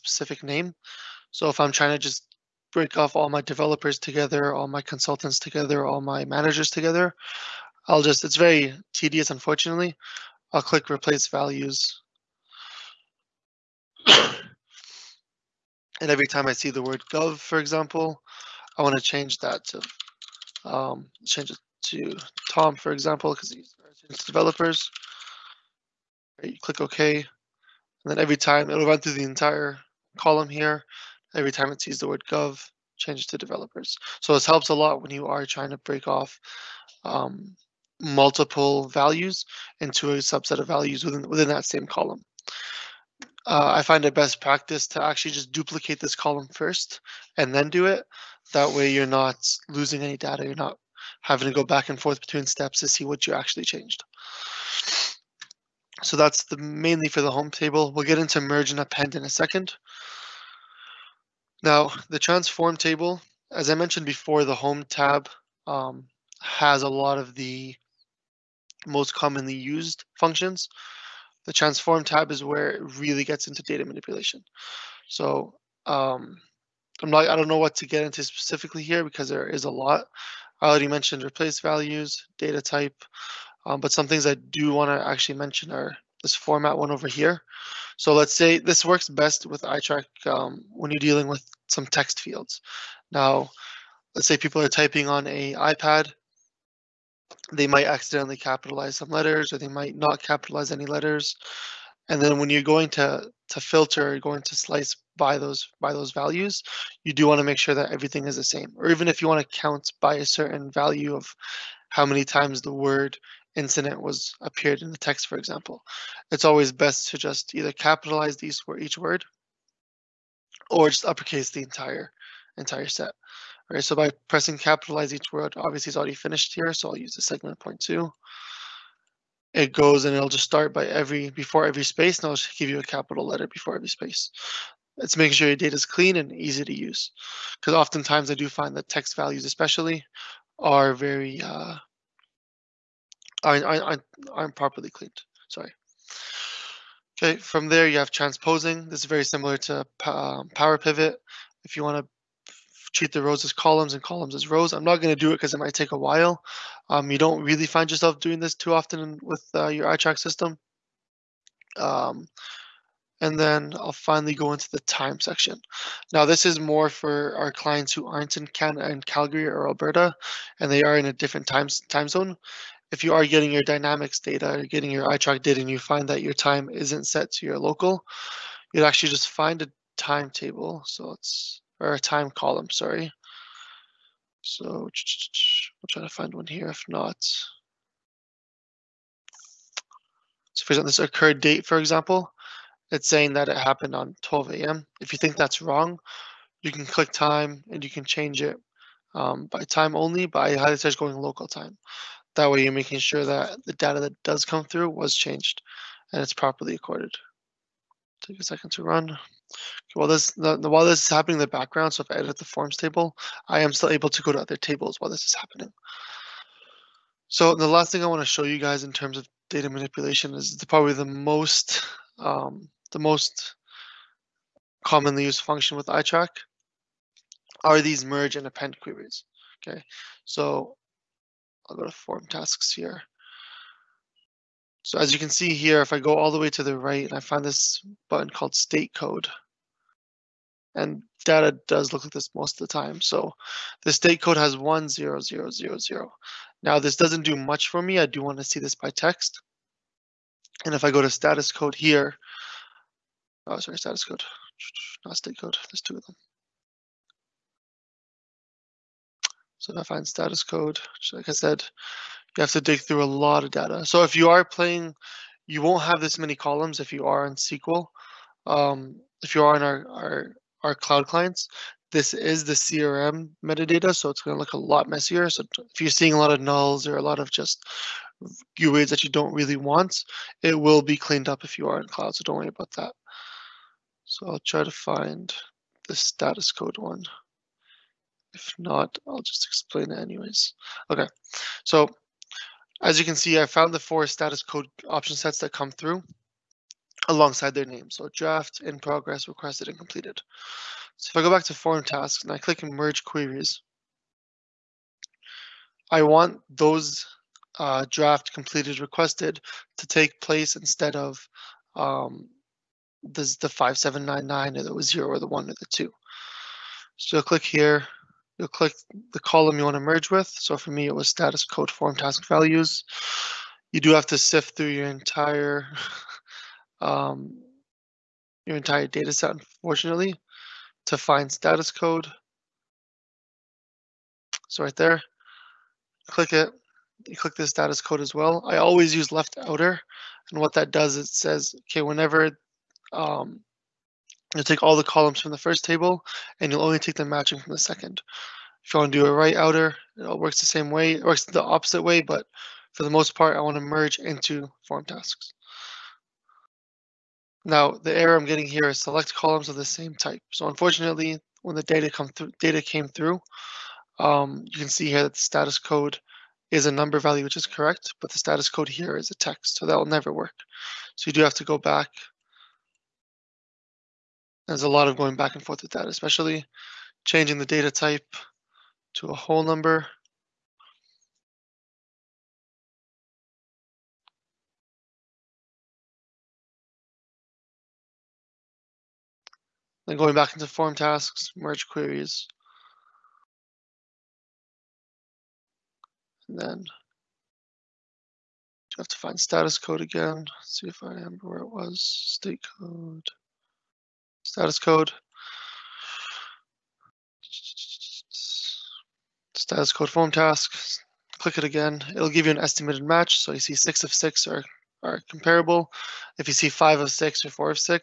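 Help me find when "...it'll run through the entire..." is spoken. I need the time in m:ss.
0:28.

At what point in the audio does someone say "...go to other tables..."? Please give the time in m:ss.
3:34.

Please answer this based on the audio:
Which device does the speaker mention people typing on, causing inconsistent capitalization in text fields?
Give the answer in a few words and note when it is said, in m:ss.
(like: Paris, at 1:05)
iPad, at 1:35.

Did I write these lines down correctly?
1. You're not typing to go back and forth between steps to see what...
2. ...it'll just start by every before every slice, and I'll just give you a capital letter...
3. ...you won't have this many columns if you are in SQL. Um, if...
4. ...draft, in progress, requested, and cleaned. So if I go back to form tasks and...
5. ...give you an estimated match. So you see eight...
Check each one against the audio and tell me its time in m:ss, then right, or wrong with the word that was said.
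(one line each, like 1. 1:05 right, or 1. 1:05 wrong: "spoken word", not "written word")
1. 0:50 wrong: "having", not "typing"
2. 2:10 wrong: "space", not "slice"
3. 4:25 right
4. 4:58 wrong: "completed", not "cleaned"
5. 6:52 wrong: "six", not "eight".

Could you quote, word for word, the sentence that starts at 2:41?
Um, and then I'll finally go into the time section.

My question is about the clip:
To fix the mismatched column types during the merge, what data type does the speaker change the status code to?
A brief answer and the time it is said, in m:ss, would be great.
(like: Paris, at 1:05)
whole number, at 6:19.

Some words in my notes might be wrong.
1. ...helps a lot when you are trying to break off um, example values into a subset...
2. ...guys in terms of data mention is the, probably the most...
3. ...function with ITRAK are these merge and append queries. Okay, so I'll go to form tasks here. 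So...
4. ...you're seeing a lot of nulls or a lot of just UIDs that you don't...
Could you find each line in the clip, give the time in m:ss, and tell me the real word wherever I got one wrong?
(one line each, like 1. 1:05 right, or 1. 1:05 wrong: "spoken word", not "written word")
1. 0:34 wrong: "multiple", not "example"
2. 3:38 wrong: "manipulation", not "mention"
3. 3:45 right
4. 4:35 right.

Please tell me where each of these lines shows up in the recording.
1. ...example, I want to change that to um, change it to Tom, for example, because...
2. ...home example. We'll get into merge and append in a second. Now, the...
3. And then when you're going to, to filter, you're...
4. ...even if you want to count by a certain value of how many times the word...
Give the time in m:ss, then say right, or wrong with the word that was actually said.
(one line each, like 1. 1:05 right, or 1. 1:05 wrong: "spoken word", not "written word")
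1. 0:17 right
2. 0:57 wrong: "table", not "example"
3. 1:42 right
4. 1:48 right.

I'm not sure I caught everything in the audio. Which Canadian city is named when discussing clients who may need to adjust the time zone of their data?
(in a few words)
Calgary.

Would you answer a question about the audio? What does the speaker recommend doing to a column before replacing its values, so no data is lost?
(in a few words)
duplicate this column.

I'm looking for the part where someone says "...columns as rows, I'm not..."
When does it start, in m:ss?
2:34.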